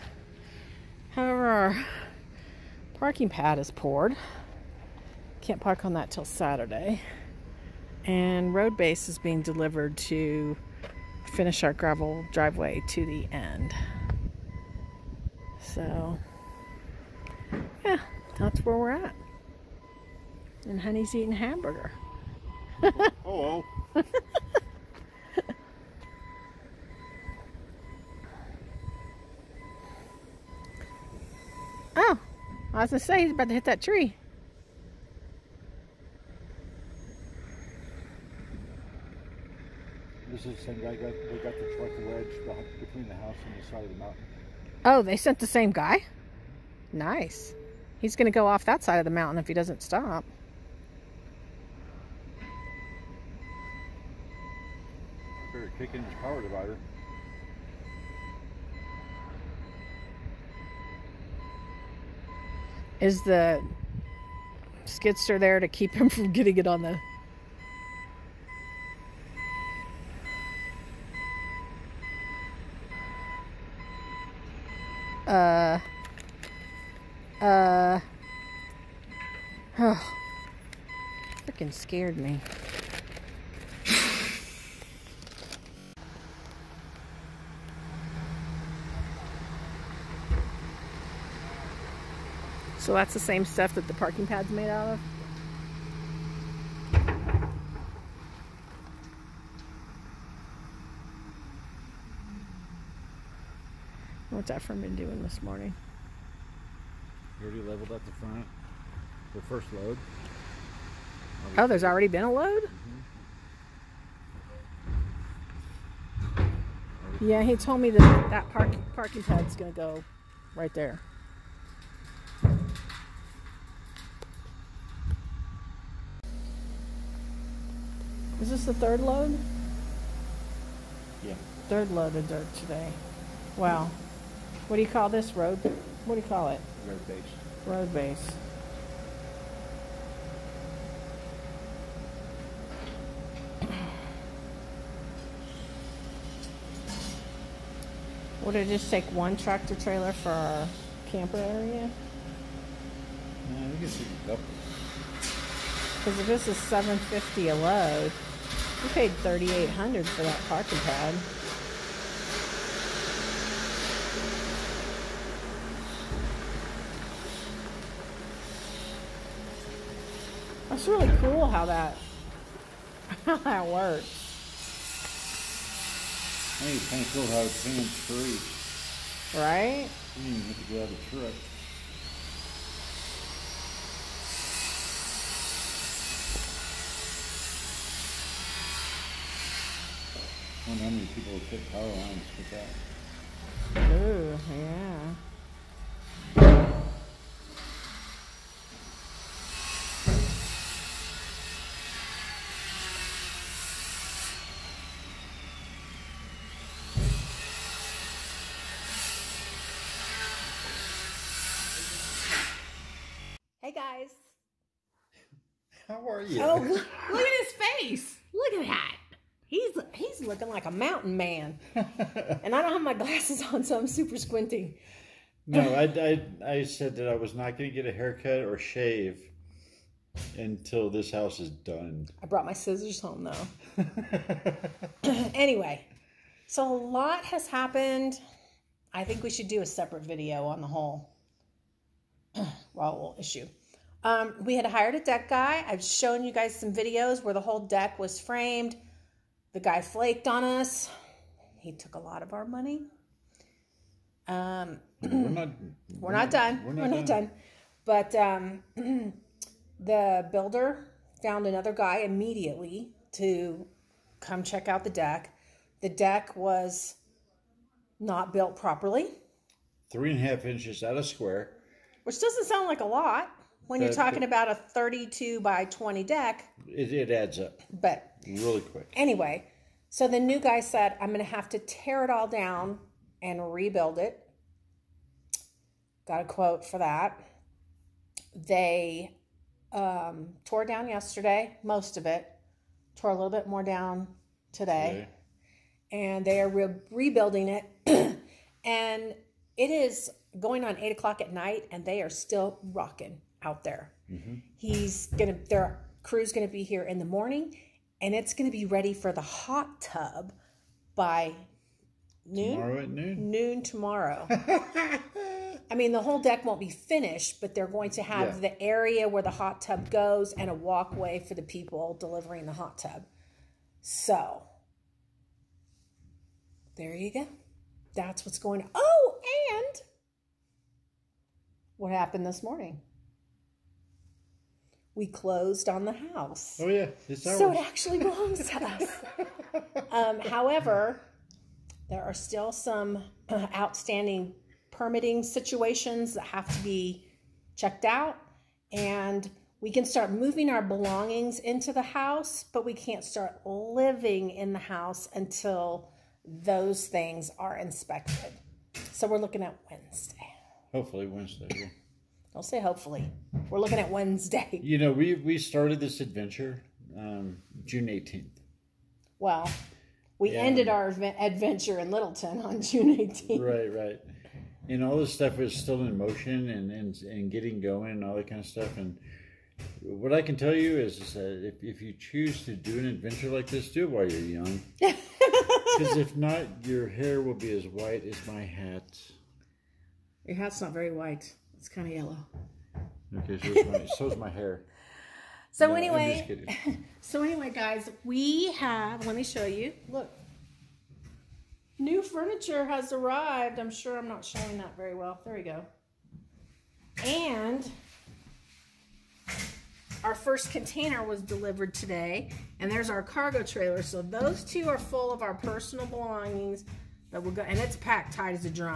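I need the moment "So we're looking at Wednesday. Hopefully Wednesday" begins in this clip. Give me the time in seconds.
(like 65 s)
358 s.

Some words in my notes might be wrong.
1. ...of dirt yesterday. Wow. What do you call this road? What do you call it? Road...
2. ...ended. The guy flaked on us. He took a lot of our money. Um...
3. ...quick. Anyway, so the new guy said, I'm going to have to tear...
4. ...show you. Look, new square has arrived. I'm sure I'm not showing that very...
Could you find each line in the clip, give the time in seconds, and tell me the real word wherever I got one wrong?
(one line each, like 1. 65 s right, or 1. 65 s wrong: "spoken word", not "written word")
1. 132 s wrong: "today", not "yesterday"
2. 248 s wrong: "framed", not "ended"
3. 278 s right
4. 399 s wrong: "furniture", not "square".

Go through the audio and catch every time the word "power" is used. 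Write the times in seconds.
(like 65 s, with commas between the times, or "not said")
56 s, 191 s.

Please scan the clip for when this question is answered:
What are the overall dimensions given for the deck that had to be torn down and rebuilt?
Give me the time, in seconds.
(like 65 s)
274 s.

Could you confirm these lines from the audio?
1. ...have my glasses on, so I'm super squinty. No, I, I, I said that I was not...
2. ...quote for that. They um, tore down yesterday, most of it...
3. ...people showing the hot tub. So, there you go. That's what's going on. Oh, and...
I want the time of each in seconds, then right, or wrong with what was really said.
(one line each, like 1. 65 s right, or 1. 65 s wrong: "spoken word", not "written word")
1. 222 s right
2. 286 s right
3. 321 s wrong: "delivering", not "showing".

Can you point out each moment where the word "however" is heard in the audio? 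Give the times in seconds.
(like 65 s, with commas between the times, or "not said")
1 s, 340 s.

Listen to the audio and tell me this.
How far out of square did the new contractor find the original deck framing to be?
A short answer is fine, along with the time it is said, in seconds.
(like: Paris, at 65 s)
3.5 inches, at 269 s.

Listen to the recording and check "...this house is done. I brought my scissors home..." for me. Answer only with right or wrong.
right.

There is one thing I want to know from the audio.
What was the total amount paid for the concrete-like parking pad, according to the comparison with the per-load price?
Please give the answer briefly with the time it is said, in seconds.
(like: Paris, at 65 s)
$3800, at 159 s.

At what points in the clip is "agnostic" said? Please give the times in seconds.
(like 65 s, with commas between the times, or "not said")
not said.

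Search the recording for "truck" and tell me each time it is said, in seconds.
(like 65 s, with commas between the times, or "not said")
41 s, 181 s.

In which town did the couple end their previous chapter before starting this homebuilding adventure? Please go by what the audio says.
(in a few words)
Littleton.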